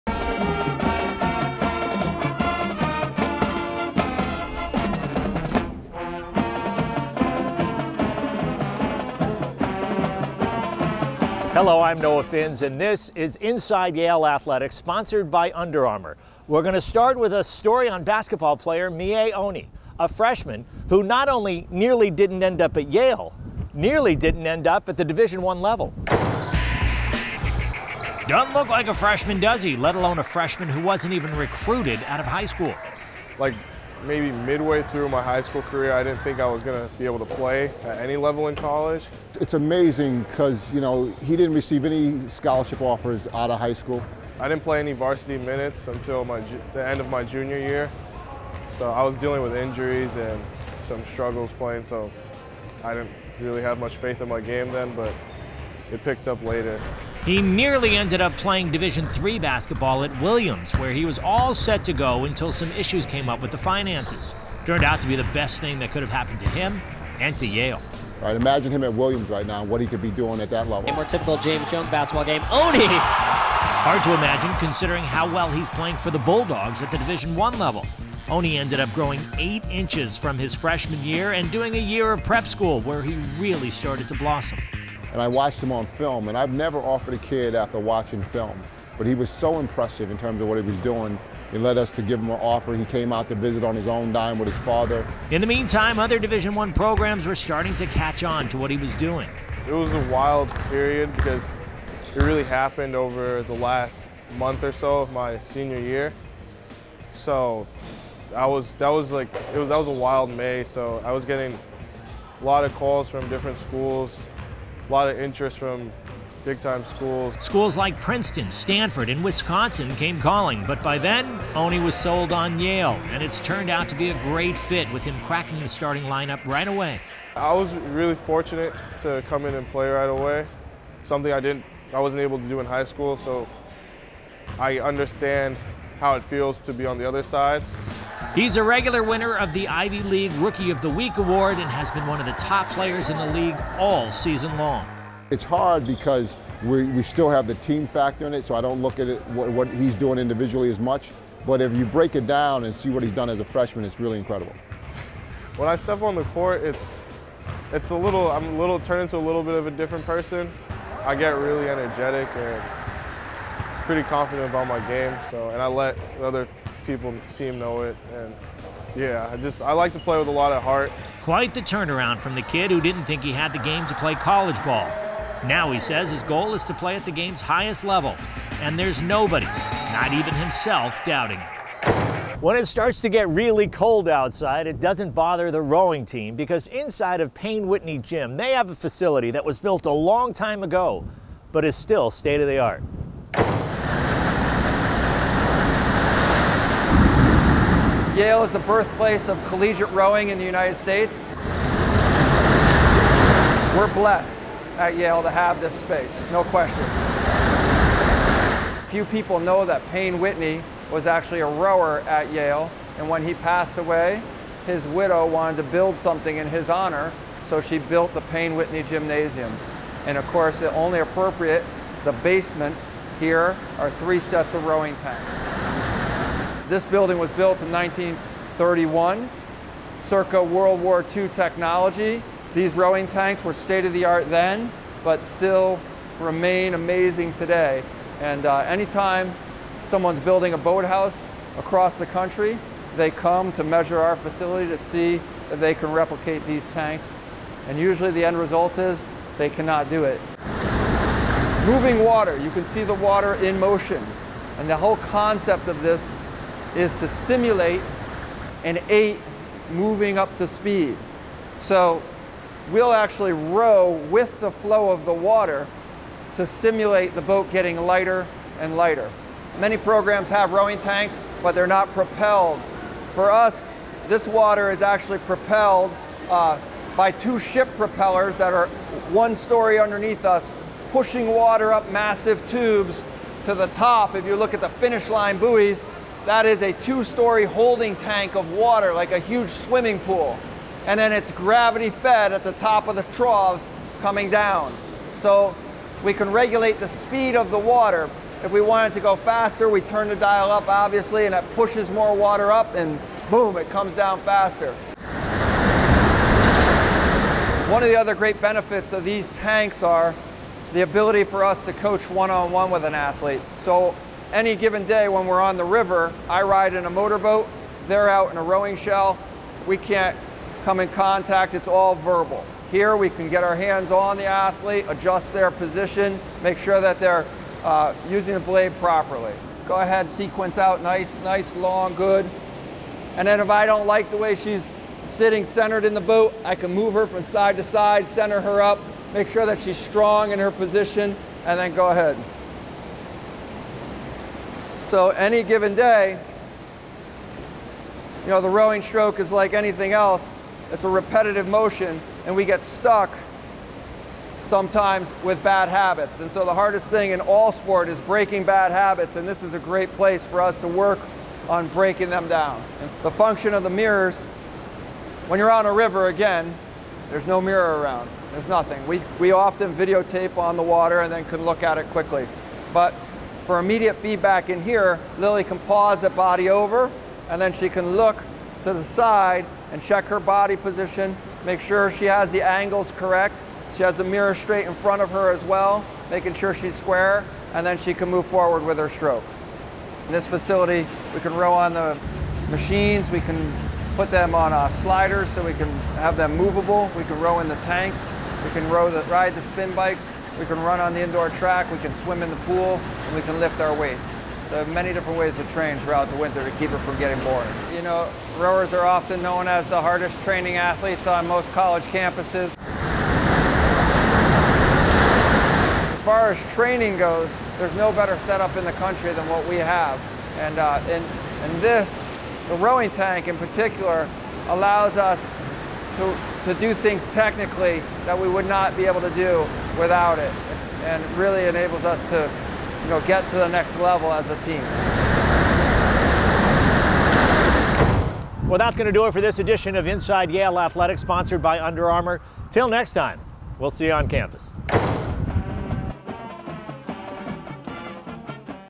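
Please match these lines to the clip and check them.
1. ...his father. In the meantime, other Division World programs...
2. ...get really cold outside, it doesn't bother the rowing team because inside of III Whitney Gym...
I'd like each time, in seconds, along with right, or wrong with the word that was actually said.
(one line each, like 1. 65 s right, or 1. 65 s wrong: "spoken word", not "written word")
1. 94 s wrong: "One", not "World"
2. 183 s wrong: "Payne", not "III".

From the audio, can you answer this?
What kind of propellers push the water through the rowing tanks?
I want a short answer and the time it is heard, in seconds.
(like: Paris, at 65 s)
ship propellers, at 277 s.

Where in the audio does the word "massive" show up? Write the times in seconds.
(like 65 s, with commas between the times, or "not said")
281 s.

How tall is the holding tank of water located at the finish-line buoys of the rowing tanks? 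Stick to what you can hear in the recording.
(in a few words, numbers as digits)
two-story.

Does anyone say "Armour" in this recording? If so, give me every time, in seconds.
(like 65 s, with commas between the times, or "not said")
15 s, 441 s.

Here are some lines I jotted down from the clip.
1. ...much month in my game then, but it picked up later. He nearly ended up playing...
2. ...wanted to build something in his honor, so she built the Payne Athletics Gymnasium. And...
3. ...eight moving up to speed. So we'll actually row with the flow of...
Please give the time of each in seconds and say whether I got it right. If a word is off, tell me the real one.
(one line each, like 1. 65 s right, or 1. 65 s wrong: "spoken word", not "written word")
1. 53 s wrong: "faith", not "month"
2. 215 s wrong: "Whitney", not "Athletics"
3. 258 s right.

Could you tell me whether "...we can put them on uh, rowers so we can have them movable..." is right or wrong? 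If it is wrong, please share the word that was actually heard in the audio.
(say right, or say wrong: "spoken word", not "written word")
wrong: "sliders", not "rowers".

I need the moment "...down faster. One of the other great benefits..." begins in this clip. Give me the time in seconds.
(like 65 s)
303 s.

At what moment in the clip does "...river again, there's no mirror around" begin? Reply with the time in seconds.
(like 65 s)
365 s.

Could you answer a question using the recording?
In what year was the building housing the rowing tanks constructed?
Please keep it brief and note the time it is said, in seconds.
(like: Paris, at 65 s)
1931, at 227 s.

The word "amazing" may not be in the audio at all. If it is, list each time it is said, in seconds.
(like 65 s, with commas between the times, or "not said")
39 s, 236 s.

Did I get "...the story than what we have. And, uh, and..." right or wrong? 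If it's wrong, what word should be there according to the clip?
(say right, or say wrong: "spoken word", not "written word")
wrong: "country", not "story".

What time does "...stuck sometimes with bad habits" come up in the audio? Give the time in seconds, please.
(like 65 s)
352 s.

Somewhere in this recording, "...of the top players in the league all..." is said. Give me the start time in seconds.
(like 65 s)
142 s.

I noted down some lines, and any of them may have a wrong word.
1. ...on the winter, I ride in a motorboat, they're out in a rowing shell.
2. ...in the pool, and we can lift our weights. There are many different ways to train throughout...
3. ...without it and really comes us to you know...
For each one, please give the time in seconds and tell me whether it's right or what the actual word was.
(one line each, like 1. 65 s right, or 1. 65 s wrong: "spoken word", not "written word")
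1. 315 s wrong: "river", not "winter"
2. 402 s right
3. 429 s wrong: "enables", not "comes".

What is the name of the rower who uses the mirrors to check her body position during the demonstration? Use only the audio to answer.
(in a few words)
Lily.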